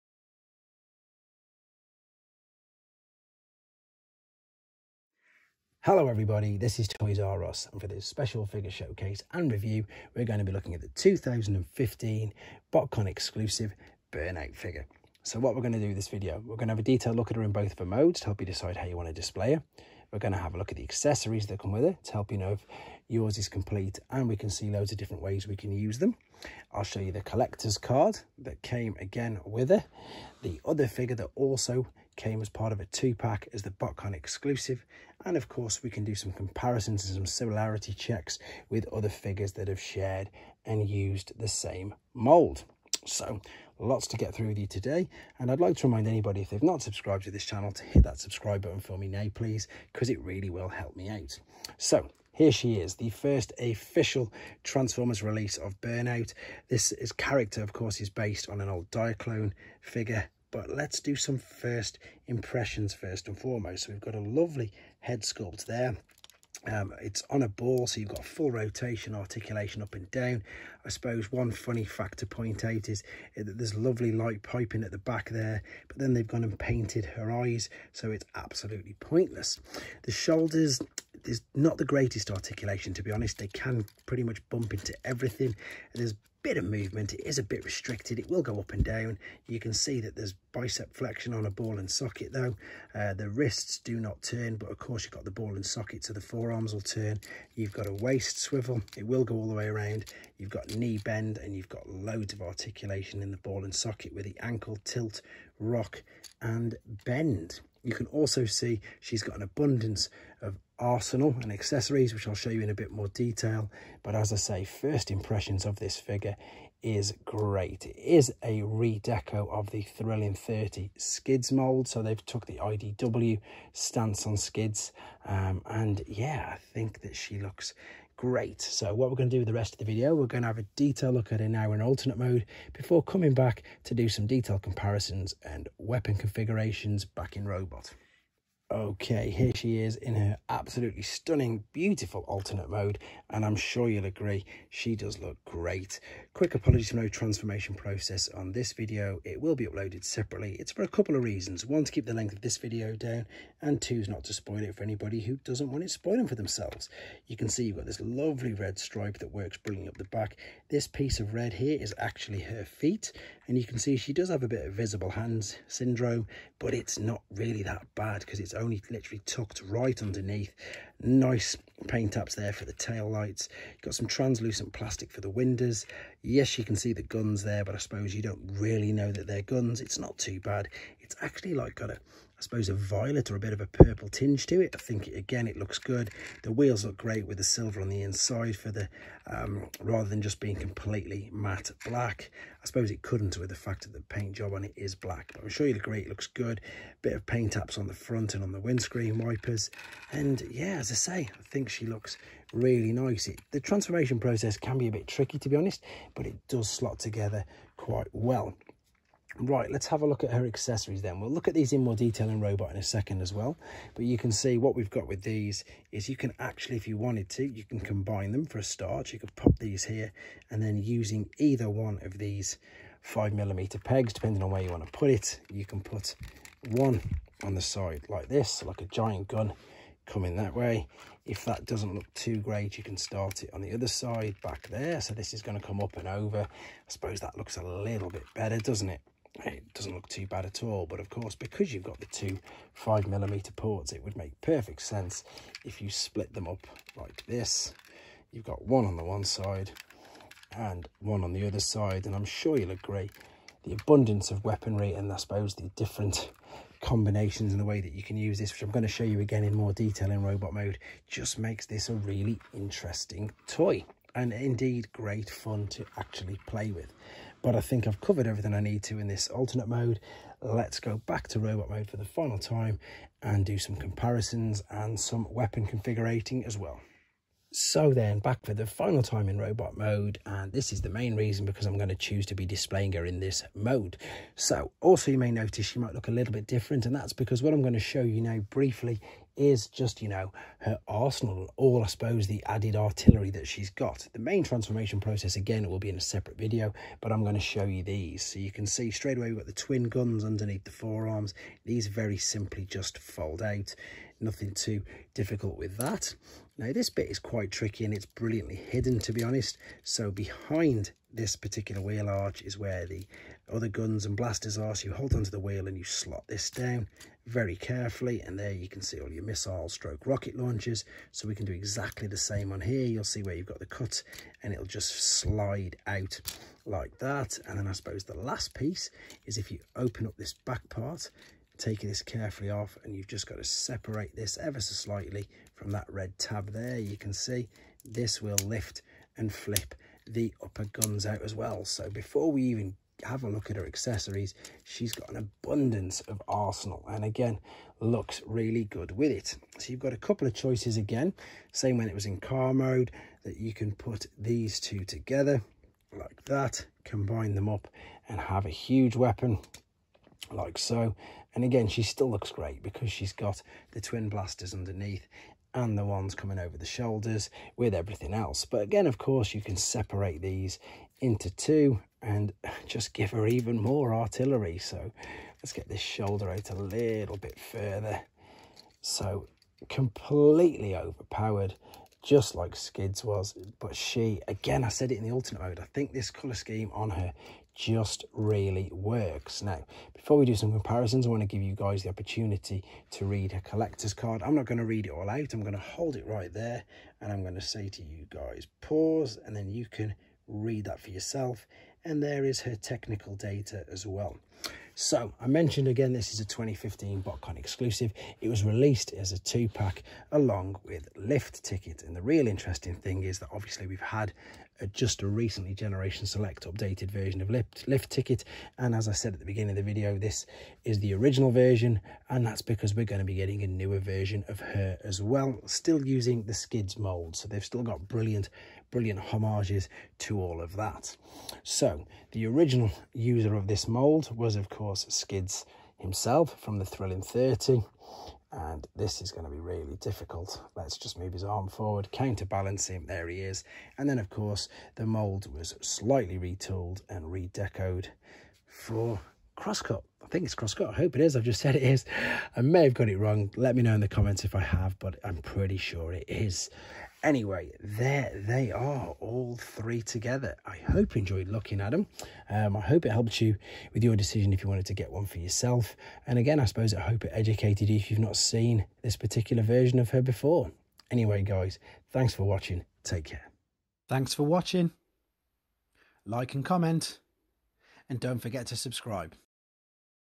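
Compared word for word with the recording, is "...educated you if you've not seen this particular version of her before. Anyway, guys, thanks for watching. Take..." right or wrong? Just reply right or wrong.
right.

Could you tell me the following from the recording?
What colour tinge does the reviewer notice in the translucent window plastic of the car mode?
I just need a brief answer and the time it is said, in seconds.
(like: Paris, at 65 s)
Violet, at 182 s.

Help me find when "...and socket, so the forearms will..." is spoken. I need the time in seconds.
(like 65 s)
95 s.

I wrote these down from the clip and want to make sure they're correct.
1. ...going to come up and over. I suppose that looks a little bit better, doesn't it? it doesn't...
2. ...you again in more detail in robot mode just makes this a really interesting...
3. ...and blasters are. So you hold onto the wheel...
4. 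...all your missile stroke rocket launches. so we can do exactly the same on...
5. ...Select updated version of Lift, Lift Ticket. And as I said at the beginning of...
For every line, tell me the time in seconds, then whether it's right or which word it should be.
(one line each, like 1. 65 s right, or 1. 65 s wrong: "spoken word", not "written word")
1. 235 s right
2. 259 s right
3. 314 s right
4. 318 s right
5. 416 s right.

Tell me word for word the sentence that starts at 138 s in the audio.
Okay, here she is in her absolutely stunning, beautiful alternate mode, and I'm sure you'll agree, she does look great.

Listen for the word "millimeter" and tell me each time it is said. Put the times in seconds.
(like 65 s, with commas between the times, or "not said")
223 s, 243 s.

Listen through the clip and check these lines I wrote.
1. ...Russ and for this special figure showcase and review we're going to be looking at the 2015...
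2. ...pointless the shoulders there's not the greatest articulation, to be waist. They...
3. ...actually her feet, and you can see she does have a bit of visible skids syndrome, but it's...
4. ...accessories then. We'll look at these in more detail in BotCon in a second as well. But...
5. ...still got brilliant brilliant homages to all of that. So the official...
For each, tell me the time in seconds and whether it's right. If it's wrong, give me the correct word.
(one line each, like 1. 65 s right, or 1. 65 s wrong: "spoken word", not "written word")
1. 7 s right
2. 78 s wrong: "honest", not "waist"
3. 161 s wrong: "hands", not "skids"
4. 210 s wrong: "Robot", not "BotCon"
5. 427 s wrong: "original", not "official".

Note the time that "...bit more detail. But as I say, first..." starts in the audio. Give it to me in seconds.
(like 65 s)
112 s.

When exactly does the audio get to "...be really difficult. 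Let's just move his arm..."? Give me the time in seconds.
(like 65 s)
439 s.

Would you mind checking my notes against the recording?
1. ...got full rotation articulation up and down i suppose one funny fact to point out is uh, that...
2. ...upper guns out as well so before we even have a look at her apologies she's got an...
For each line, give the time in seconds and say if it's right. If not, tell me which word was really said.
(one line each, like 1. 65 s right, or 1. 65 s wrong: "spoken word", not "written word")
1. 68 s right
2. 340 s wrong: "accessories", not "apologies".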